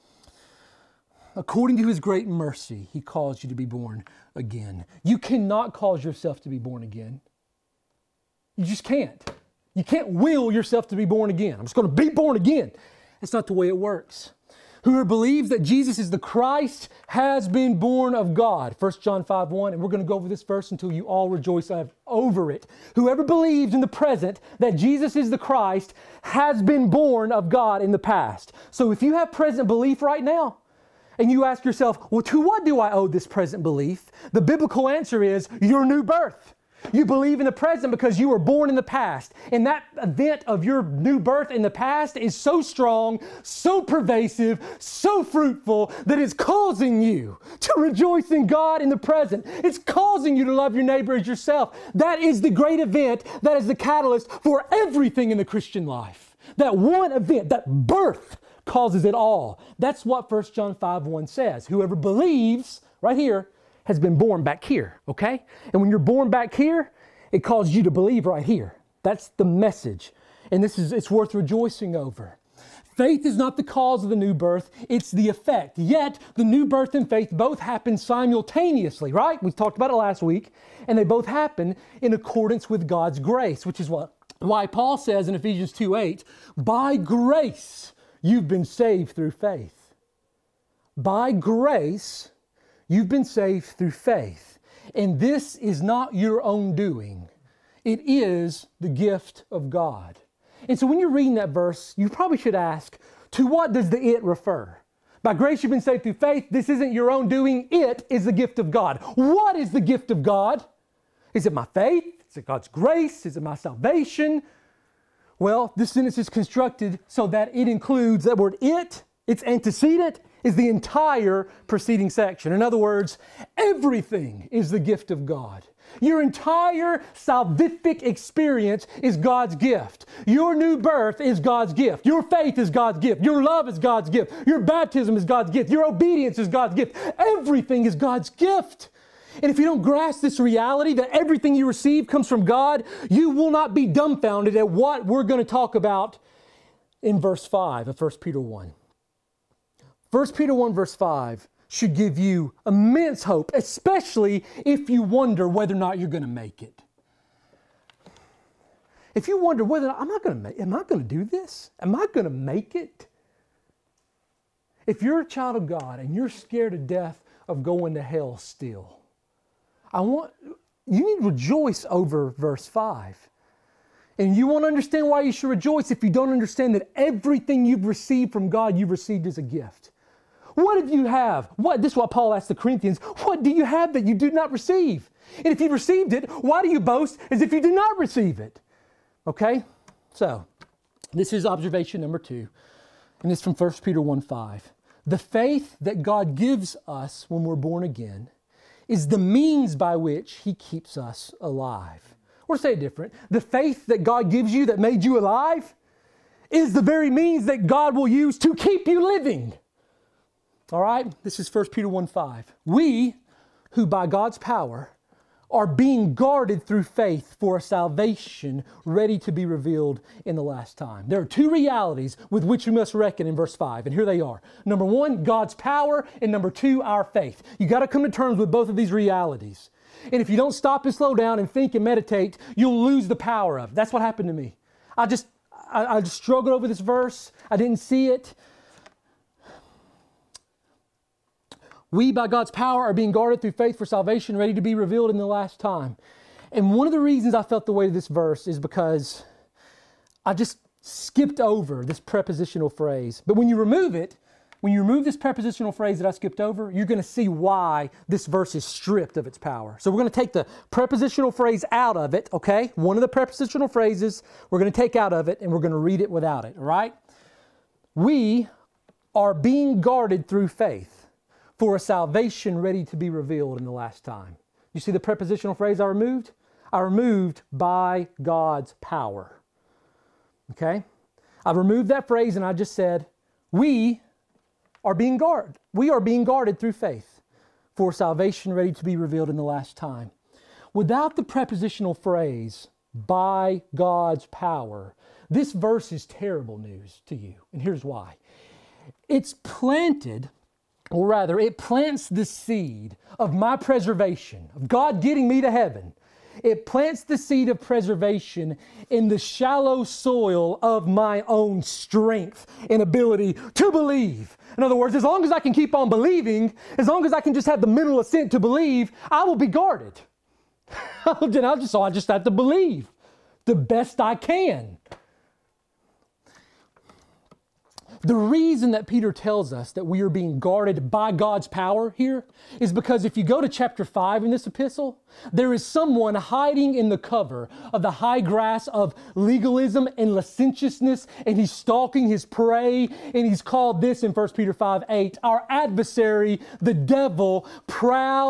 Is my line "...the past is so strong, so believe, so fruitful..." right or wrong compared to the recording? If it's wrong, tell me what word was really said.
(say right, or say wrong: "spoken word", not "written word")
wrong: "pervasive", not "believe".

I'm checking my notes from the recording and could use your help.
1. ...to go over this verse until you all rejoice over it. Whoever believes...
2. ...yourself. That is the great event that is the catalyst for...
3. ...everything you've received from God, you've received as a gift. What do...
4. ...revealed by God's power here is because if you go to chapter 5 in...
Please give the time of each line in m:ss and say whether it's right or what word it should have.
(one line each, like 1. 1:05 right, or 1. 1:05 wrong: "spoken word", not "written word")
1. 0:20 right
2. 0:51 right
3. 2:56 right
4. 5:30 wrong: "guarded", not "revealed".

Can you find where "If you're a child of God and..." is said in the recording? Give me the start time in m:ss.
2:44.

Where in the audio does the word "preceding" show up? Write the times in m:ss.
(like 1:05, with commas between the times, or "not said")
2:01.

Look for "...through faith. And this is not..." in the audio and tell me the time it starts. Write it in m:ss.
1:33.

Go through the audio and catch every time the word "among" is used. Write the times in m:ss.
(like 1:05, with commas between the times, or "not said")
not said.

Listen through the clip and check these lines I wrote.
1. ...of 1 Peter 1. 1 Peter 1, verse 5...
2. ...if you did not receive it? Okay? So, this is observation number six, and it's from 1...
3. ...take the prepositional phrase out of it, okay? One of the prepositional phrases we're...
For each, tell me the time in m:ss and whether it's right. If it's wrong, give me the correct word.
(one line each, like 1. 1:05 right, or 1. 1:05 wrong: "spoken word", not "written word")
1. 2:27 right
2. 3:07 wrong: "two", not "six"
3. 4:20 right.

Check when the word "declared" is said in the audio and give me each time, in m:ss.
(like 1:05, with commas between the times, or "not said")
not said.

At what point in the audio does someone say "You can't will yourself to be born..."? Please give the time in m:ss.
0:09.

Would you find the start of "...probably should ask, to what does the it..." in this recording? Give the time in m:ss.
1:42.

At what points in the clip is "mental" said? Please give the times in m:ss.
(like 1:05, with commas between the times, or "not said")
5:17.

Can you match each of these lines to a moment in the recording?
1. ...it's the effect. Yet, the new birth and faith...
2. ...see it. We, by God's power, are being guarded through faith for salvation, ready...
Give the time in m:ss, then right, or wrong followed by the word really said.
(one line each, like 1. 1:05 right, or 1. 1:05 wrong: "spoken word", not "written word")
1. 1:14 right
2. 3:57 right.